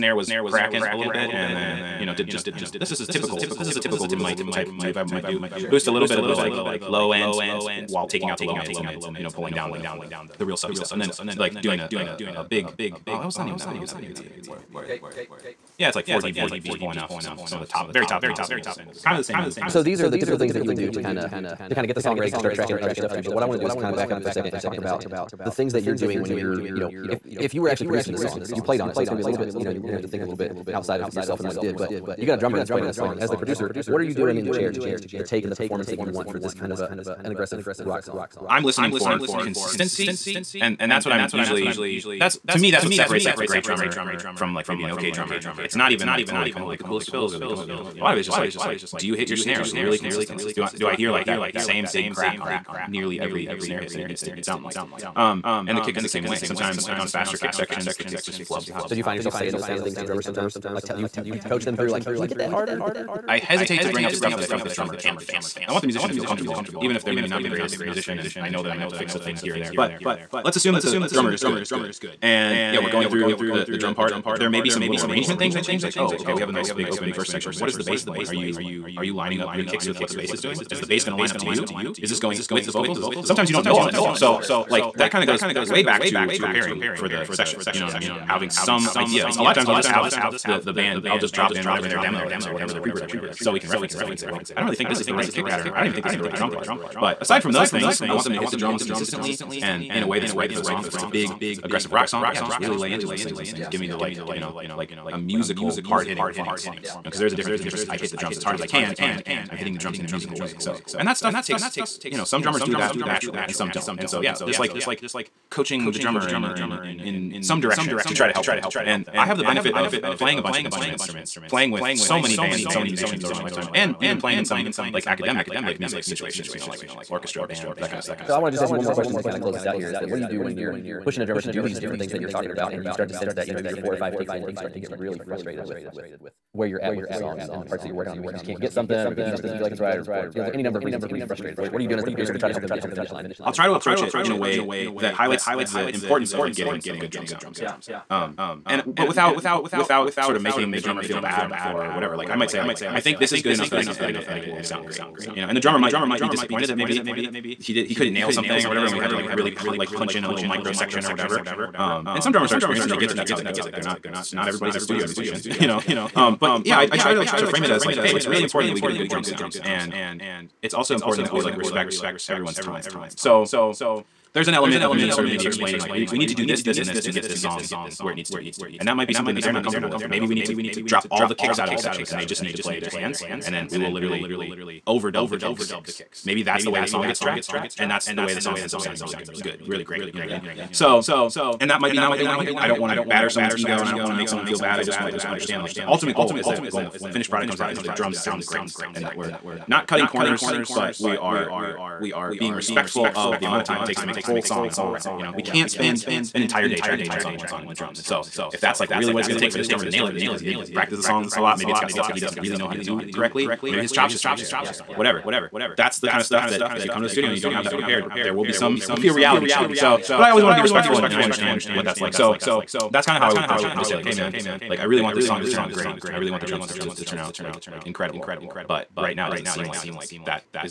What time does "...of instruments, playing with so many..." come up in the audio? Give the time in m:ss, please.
2:00.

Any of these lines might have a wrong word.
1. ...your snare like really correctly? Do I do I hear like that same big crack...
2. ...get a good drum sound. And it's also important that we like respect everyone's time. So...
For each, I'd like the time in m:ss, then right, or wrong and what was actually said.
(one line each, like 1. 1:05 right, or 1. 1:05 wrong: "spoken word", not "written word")
1. 0:49 wrong: "consistently", not "correctly"
2. 2:48 right.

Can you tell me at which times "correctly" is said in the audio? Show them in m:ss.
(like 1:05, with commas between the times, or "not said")
3:33.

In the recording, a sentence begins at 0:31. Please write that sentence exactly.
But you got a drummer that's playing on this song.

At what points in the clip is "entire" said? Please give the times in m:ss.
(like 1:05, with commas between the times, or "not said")
3:26.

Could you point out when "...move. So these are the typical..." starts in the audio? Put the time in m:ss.
0:19.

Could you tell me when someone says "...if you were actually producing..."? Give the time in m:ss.
0:27.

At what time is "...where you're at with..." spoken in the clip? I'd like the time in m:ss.
2:16.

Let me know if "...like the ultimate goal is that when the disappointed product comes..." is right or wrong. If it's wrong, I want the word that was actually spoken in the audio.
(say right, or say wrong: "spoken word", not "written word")
wrong: "finished", not "disappointed".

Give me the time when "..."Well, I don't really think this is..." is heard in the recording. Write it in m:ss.
1:34.